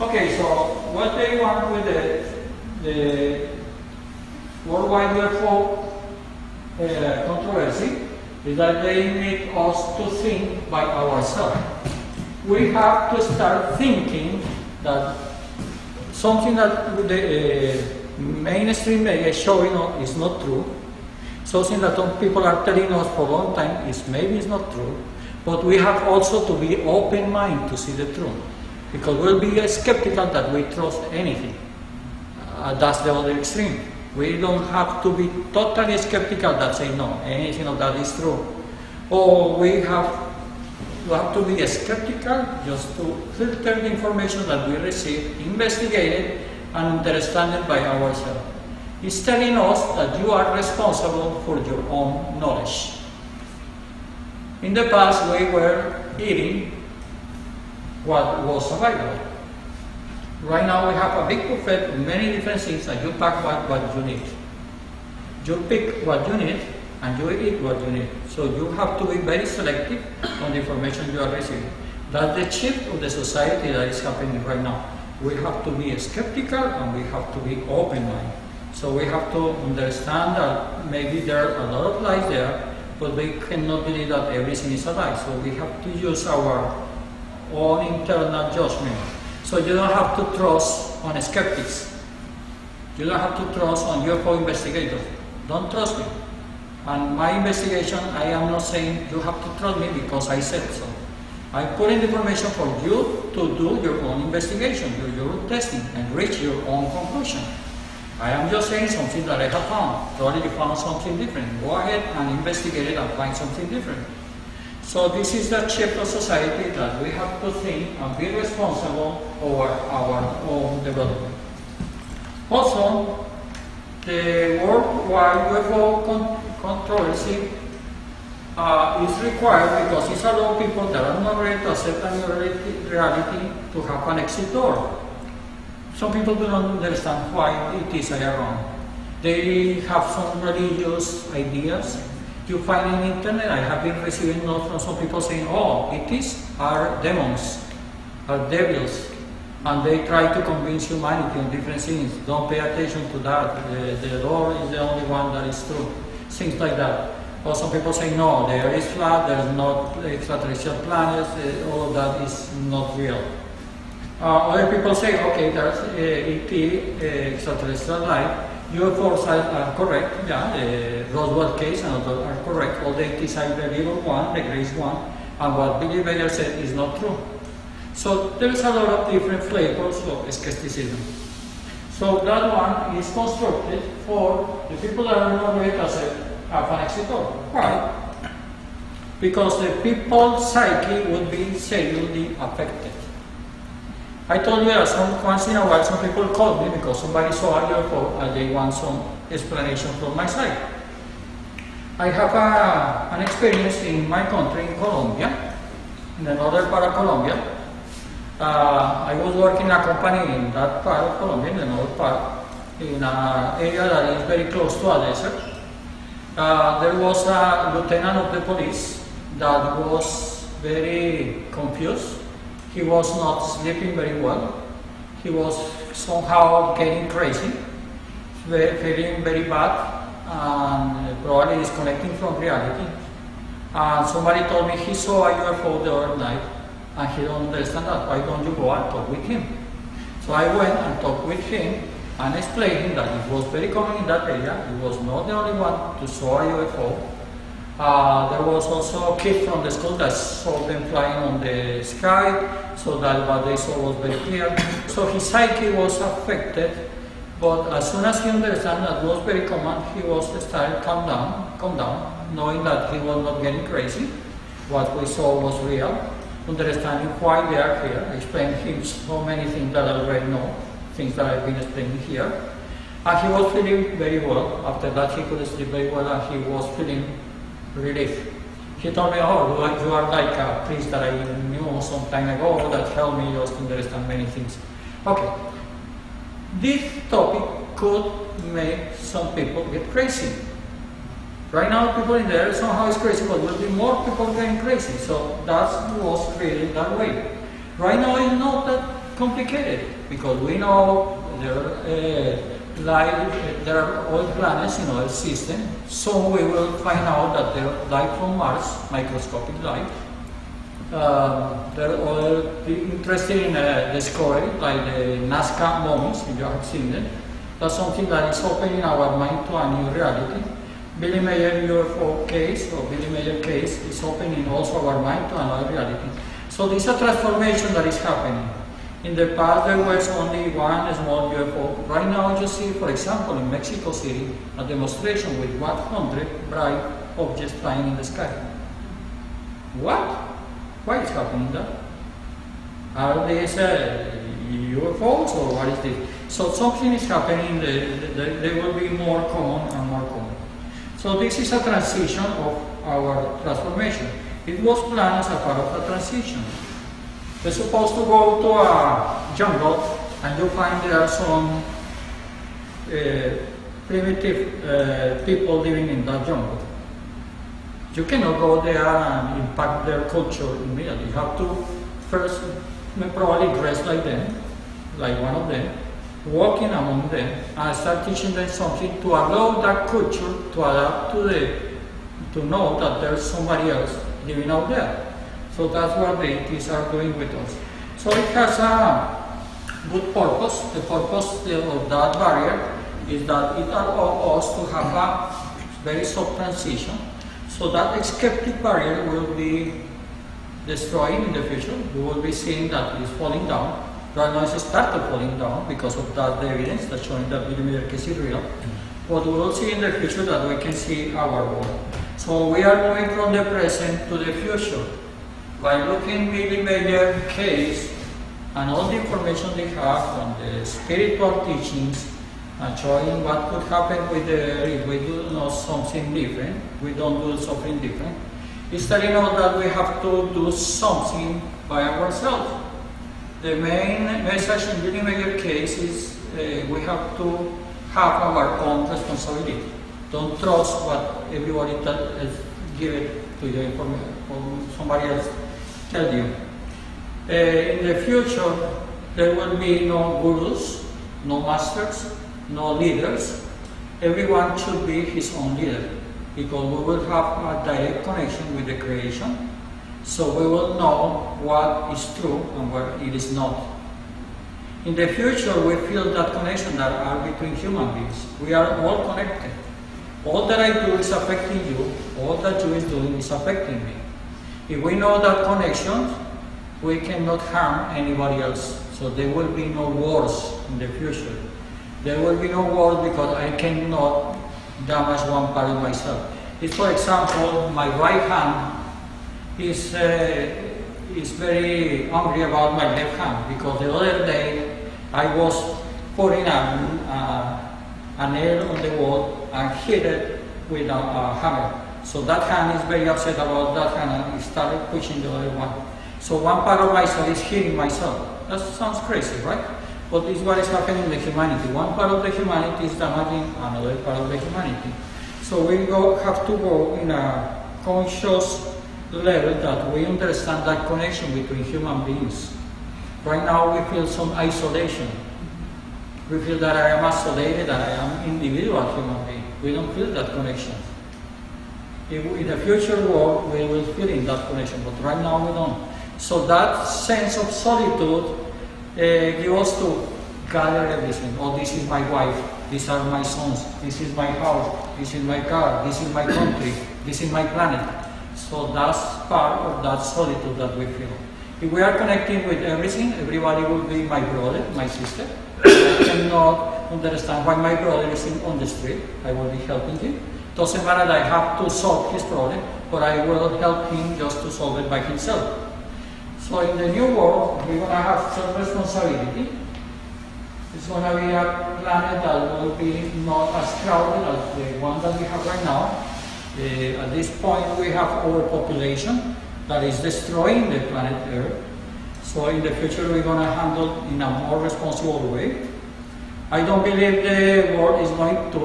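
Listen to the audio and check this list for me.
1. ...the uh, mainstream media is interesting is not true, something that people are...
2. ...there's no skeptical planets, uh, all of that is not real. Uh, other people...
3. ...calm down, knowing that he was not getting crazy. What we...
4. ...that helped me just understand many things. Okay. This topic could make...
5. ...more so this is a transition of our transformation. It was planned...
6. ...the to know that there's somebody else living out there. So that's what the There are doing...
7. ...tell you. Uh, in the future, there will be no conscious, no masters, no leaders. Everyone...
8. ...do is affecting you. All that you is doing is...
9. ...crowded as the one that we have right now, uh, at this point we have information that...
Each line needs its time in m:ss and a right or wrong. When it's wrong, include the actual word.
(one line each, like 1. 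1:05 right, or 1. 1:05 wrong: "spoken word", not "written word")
1. 0:17 wrong: "showing", not "interesting"
2. 2:39 wrong: "extraterrestrial", not "skeptical"
3. 4:21 right
4. 4:42 right
5. 5:49 right
6. 6:21 wrong: "ETs", not "There"
7. 7:25 wrong: "gurus", not "conscious"
8. 7:50 right
9. 9:33 wrong: "overpopulation", not "information".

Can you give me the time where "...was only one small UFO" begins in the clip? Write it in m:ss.
5:29.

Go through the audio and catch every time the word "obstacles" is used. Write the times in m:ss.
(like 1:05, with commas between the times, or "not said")
not said.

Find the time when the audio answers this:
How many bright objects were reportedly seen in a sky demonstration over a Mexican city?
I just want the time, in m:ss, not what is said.
5:35.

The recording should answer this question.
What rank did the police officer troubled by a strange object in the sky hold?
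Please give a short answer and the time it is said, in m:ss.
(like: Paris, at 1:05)
lieutenant, at 3:37.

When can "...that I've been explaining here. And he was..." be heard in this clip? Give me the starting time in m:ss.
4:31.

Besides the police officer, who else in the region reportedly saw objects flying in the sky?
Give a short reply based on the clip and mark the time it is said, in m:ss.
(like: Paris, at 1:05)
a kid from the school, at 4:09.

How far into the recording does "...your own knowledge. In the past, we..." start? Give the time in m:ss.
0:51.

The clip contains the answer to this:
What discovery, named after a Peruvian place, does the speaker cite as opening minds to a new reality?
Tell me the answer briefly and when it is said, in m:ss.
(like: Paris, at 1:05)
Nazca mummies, at 5:15.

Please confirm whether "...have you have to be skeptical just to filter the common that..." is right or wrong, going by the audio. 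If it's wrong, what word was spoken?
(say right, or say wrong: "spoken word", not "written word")
wrong: "information", not "common".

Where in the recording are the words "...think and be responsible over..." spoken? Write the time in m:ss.
1:57.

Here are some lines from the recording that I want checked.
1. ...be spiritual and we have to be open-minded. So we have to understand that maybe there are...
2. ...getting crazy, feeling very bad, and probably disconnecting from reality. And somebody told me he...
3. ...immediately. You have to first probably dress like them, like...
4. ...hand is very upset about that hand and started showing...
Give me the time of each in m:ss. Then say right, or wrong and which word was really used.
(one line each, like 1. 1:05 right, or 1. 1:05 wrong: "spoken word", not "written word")
1. 1:15 wrong: "skeptical", not "spiritual"
2. 3:46 right
3. 6:10 right
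4. 8:22 wrong: "pushing", not "showing".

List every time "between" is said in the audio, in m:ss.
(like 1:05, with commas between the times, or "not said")
7:47, 8:41.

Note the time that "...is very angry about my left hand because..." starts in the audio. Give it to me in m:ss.
8:11.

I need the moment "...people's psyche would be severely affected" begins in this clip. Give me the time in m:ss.
3:09.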